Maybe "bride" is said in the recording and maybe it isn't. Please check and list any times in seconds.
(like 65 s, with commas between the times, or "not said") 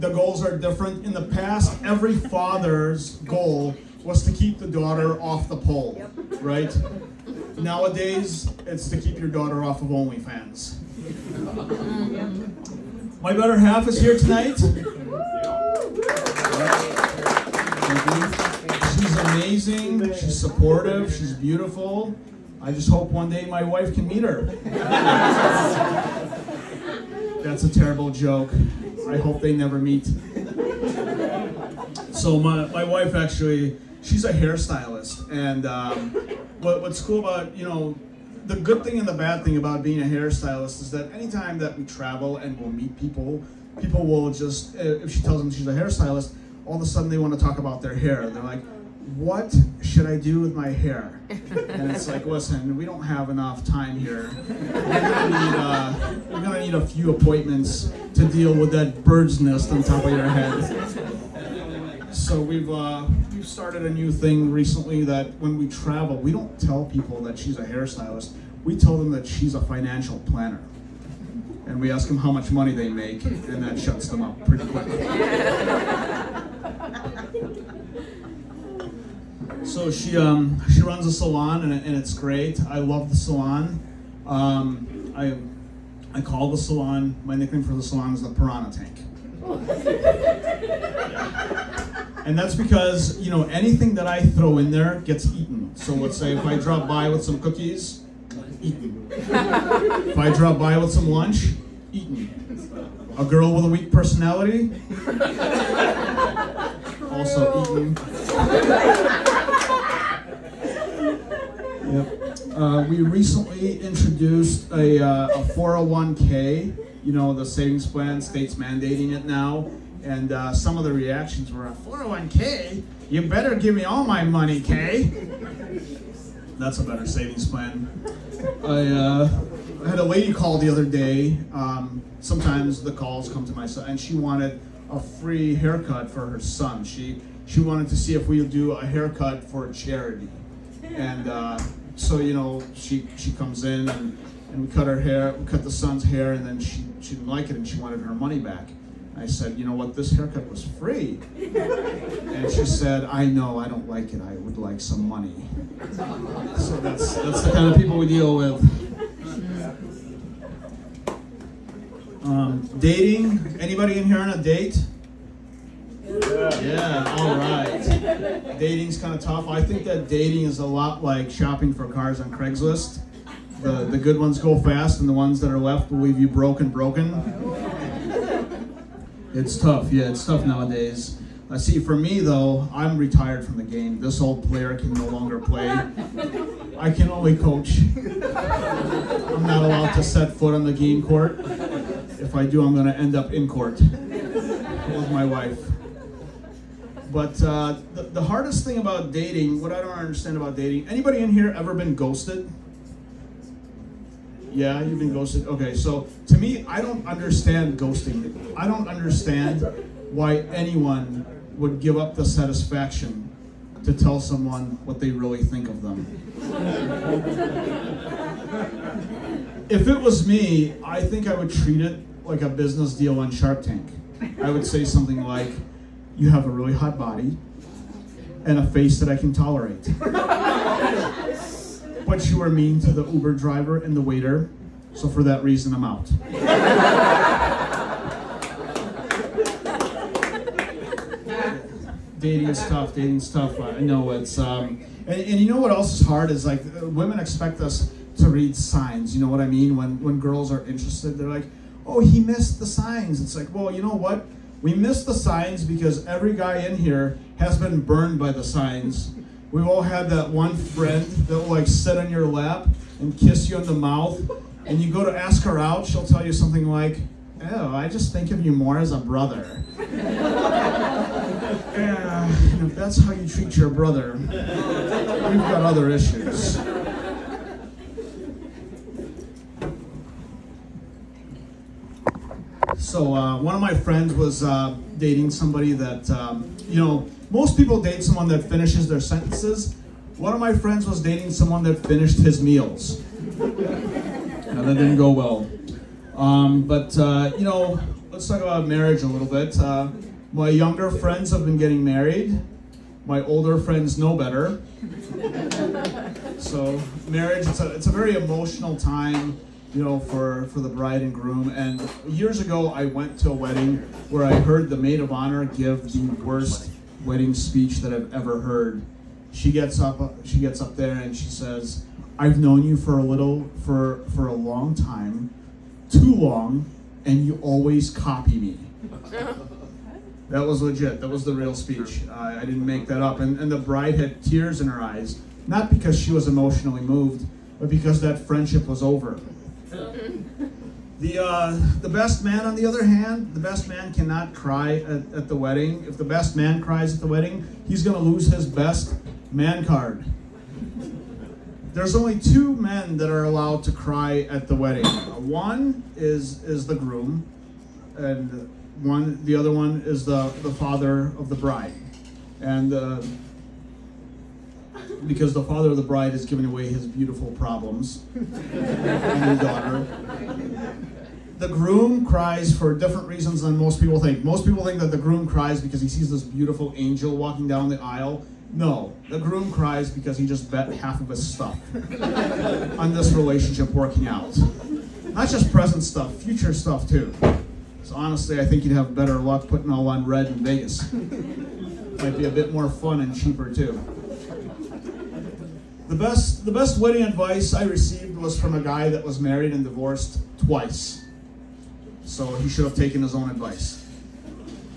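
310 s, 333 s, 361 s, 365 s.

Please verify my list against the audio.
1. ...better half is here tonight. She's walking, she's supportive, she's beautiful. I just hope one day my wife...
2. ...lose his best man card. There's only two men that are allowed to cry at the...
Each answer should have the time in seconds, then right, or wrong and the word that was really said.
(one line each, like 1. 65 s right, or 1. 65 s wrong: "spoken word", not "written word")
1. 13 s wrong: "amazing", not "walking"
2. 348 s right.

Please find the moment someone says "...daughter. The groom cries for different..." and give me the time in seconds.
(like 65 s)
369 s.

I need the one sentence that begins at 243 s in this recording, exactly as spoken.
I know it's, um, and, and you know what else is hard is like women expect us to read signs.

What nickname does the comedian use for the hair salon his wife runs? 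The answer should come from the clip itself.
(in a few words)
Piranha Tank.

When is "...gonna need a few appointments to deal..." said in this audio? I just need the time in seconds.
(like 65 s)
56 s.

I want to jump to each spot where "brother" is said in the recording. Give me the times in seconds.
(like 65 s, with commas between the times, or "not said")
268 s, 273 s.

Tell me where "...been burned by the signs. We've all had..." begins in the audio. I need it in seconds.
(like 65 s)
257 s.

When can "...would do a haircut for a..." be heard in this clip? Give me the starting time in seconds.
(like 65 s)
138 s.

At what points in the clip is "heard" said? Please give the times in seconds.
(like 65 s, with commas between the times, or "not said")
314 s, 318 s.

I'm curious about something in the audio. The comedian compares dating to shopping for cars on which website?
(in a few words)
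Craigslist.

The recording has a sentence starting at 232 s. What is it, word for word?
but you were mean to the Uber driver and the waiter, so for that reason, I'm out.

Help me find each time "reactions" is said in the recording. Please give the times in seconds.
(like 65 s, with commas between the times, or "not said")
120 s.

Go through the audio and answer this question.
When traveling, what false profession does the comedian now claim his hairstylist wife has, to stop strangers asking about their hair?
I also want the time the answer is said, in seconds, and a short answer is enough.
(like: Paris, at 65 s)
Financial planner, at 69 s.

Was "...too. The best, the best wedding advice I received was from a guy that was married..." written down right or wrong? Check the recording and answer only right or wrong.
right.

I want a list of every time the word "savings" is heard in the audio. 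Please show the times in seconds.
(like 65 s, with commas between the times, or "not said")
117 s, 127 s.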